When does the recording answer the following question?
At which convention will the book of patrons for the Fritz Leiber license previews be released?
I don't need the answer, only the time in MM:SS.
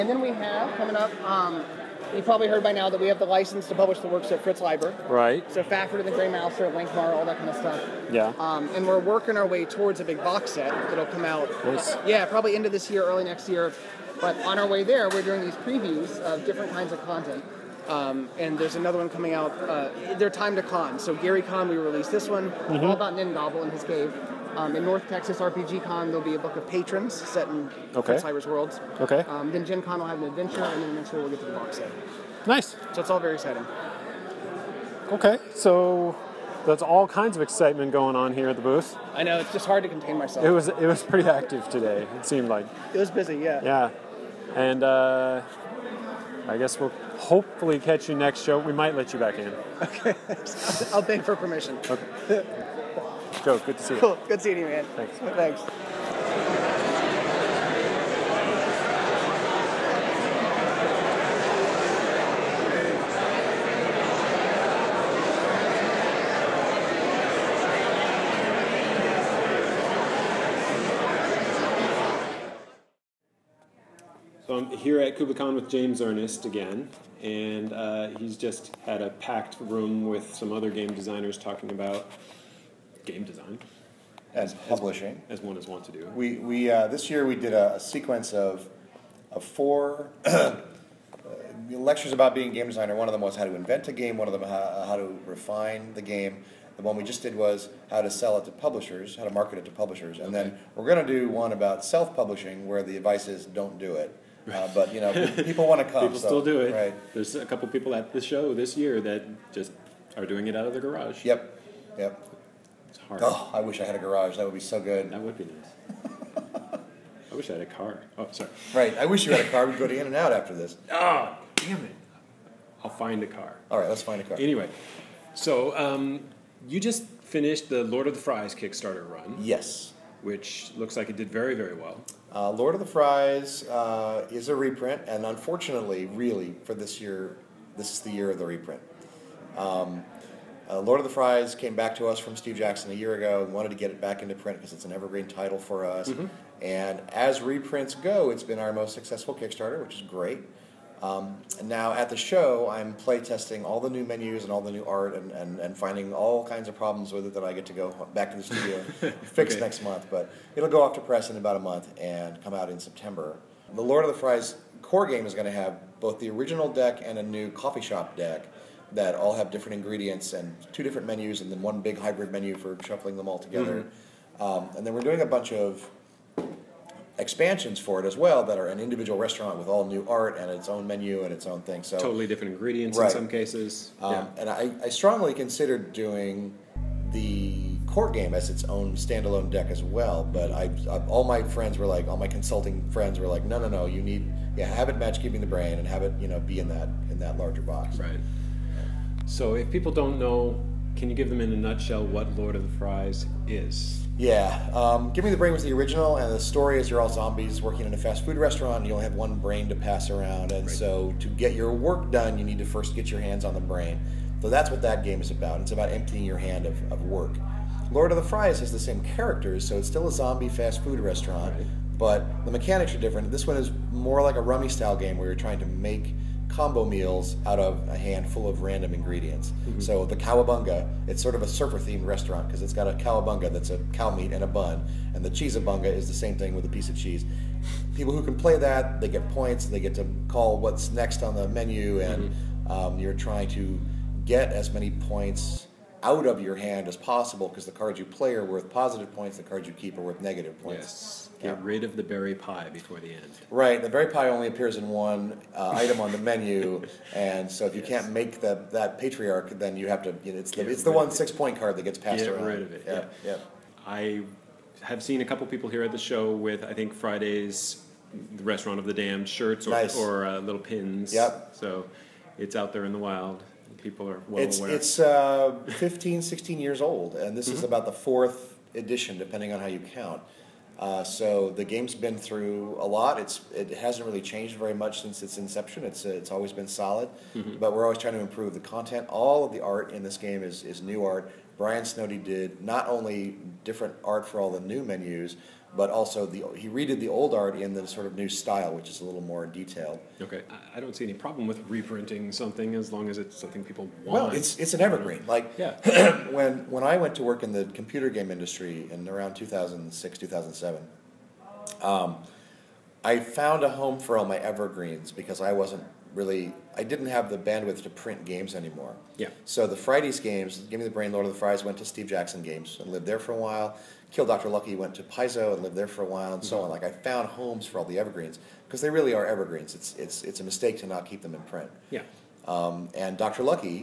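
00:24.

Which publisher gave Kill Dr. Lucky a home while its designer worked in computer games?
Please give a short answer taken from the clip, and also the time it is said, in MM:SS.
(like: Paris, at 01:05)
Paizo, at 05:25.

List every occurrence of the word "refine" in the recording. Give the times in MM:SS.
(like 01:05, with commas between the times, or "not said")
01:35.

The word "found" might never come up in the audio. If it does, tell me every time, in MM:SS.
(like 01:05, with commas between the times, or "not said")
05:13, 05:26.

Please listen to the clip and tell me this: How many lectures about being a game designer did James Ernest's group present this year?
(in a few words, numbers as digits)
4.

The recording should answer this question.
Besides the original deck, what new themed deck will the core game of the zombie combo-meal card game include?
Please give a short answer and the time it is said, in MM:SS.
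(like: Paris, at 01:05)
coffee shop deck, at 02:47.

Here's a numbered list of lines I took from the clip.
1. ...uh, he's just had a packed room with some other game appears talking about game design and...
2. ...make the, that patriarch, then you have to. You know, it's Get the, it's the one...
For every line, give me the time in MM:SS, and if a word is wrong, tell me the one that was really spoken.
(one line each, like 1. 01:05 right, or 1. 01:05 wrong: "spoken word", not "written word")
1. 01:17 wrong: "designers", not "appears"
2. 04:18 right.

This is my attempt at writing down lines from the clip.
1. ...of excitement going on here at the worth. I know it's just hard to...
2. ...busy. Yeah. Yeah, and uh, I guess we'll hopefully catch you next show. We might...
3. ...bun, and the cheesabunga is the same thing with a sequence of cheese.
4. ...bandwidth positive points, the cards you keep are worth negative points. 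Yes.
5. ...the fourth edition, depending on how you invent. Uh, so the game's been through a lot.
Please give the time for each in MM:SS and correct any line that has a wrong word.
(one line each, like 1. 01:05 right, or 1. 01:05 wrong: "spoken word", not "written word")
1. 00:37 wrong: "booth", not "worth"
2. 00:43 right
3. 03:54 wrong: "piece", not "sequence"
4. 04:08 wrong: "worth", not "bandwidth"
5. 04:37 wrong: "count", not "invent".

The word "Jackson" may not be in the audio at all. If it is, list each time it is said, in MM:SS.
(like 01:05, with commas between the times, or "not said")
02:22, 05:22.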